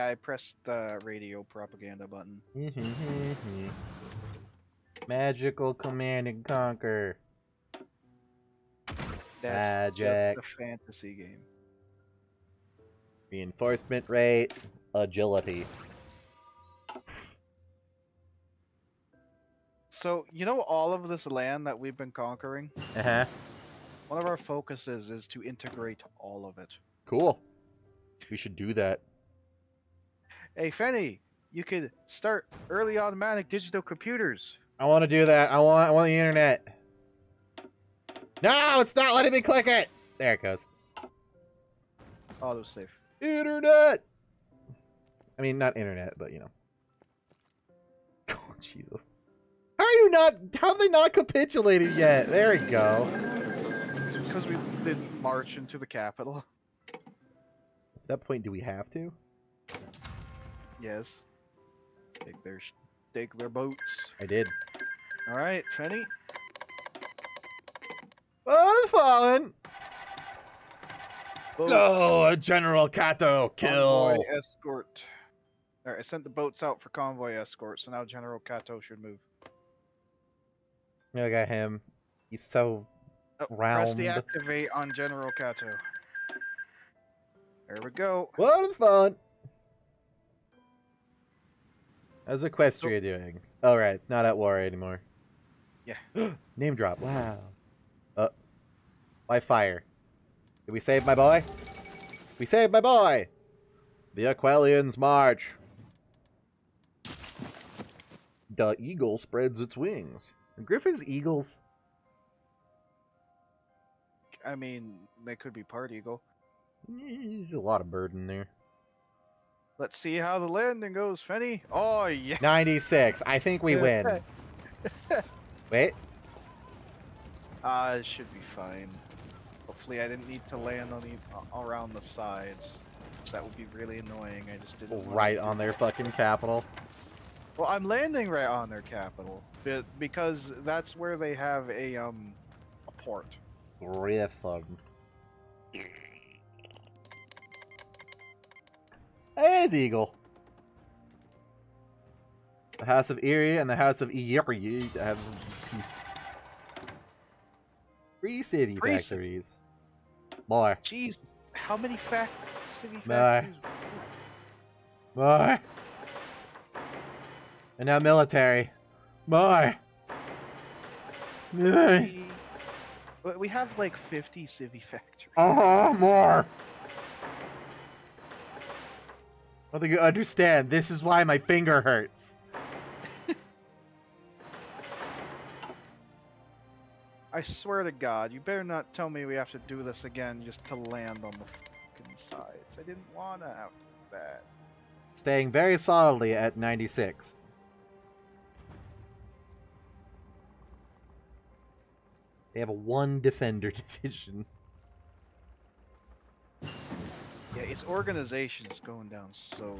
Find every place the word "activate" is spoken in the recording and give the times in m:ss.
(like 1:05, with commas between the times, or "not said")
1:24.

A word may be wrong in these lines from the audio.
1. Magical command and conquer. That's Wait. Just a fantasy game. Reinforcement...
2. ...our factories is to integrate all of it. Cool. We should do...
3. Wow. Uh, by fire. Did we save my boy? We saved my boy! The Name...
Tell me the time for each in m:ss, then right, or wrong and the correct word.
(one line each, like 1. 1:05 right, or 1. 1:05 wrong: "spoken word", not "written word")
1. 0:05 wrong: "Magic", not "Wait"
2. 0:24 wrong: "focuses", not "factories"
3. 1:36 wrong: "Aquileians", not "Name".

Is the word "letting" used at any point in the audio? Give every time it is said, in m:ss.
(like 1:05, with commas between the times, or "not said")
0:39.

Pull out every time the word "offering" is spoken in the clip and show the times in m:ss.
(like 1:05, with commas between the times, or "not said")
not said.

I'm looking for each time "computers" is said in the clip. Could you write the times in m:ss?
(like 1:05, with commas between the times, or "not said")
0:33.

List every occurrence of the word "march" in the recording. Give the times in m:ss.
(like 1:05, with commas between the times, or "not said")
0:55, 1:44.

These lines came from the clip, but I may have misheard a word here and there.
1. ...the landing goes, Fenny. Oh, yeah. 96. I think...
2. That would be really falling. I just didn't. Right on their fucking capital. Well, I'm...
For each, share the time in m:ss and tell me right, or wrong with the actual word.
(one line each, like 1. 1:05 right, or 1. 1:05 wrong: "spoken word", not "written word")
1. 2:00 right
2. 2:13 wrong: "annoying", not "falling".